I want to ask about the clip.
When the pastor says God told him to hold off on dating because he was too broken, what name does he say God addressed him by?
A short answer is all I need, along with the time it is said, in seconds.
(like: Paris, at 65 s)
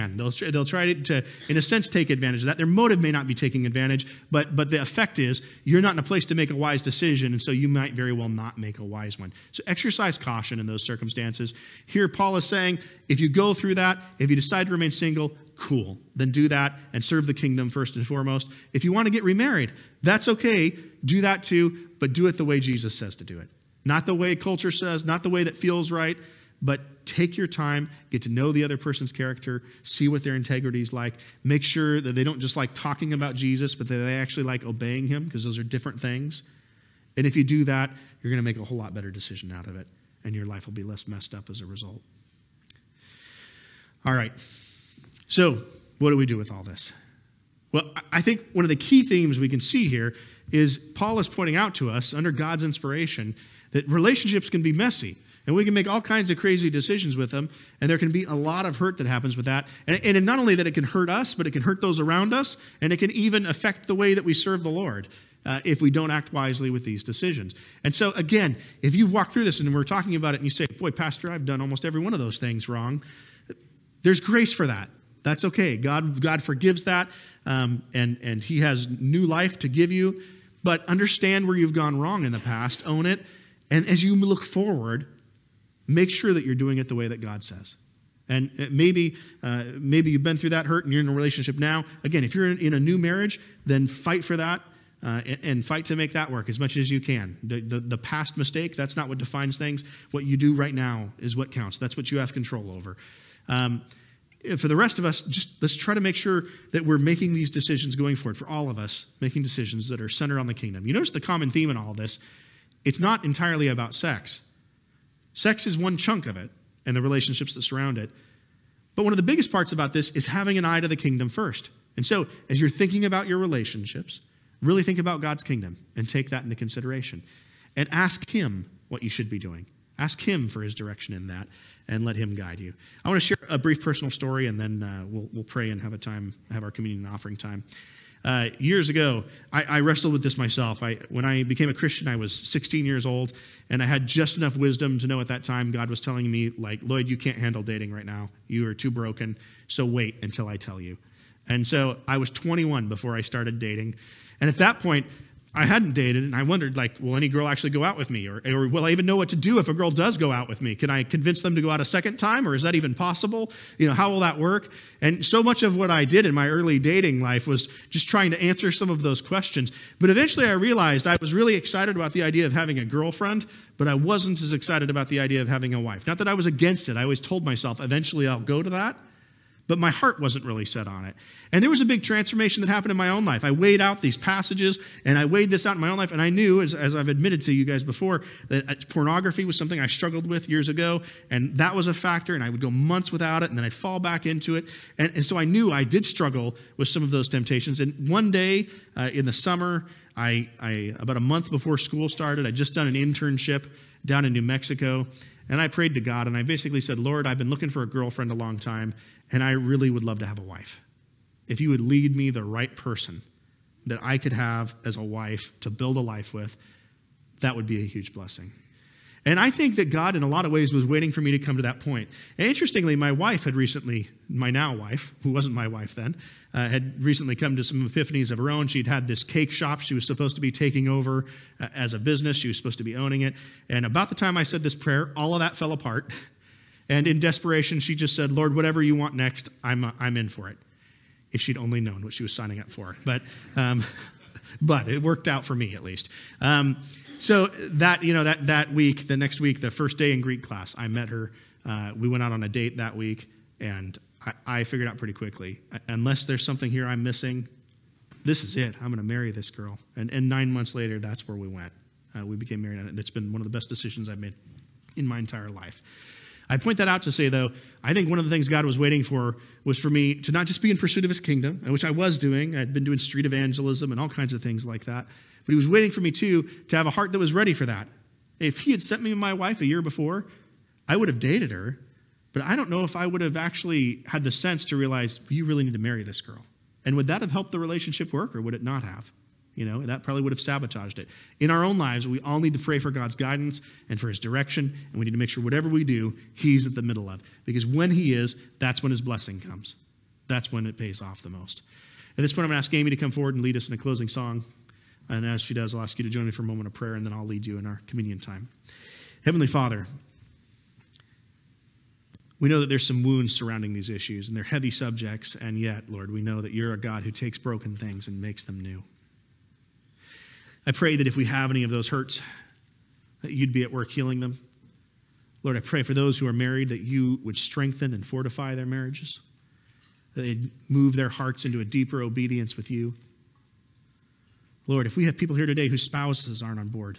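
Lloyd, at 146 s.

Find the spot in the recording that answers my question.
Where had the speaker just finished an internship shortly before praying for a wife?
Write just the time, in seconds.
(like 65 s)
204 s.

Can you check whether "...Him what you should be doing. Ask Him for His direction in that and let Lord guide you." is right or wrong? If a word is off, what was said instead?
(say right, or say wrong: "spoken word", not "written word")
wrong: "Him", not "Lord".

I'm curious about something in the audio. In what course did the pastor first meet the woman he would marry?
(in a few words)
Greek class.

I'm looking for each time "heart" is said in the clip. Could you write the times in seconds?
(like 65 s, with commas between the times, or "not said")
179 s, 276 s, 331 s.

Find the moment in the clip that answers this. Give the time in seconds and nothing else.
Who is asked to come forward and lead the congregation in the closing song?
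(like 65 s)
302 s.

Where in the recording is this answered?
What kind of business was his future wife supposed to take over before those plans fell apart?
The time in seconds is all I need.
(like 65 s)
229 s.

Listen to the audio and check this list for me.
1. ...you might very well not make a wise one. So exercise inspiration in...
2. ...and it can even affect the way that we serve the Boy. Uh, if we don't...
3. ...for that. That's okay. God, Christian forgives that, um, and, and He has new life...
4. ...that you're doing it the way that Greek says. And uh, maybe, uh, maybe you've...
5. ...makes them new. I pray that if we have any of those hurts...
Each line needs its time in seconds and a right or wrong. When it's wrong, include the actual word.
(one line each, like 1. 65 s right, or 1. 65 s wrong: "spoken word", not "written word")
1. 7 s wrong: "caution", not "inspiration"
2. 62 s wrong: "Lord", not "Boy"
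3. 74 s wrong: "God", not "Christian"
4. 86 s wrong: "God", not "Greek"
5. 318 s right.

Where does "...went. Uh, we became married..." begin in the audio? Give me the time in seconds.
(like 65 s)
261 s.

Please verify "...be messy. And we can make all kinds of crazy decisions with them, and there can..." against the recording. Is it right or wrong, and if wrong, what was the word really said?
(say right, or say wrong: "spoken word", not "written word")
right.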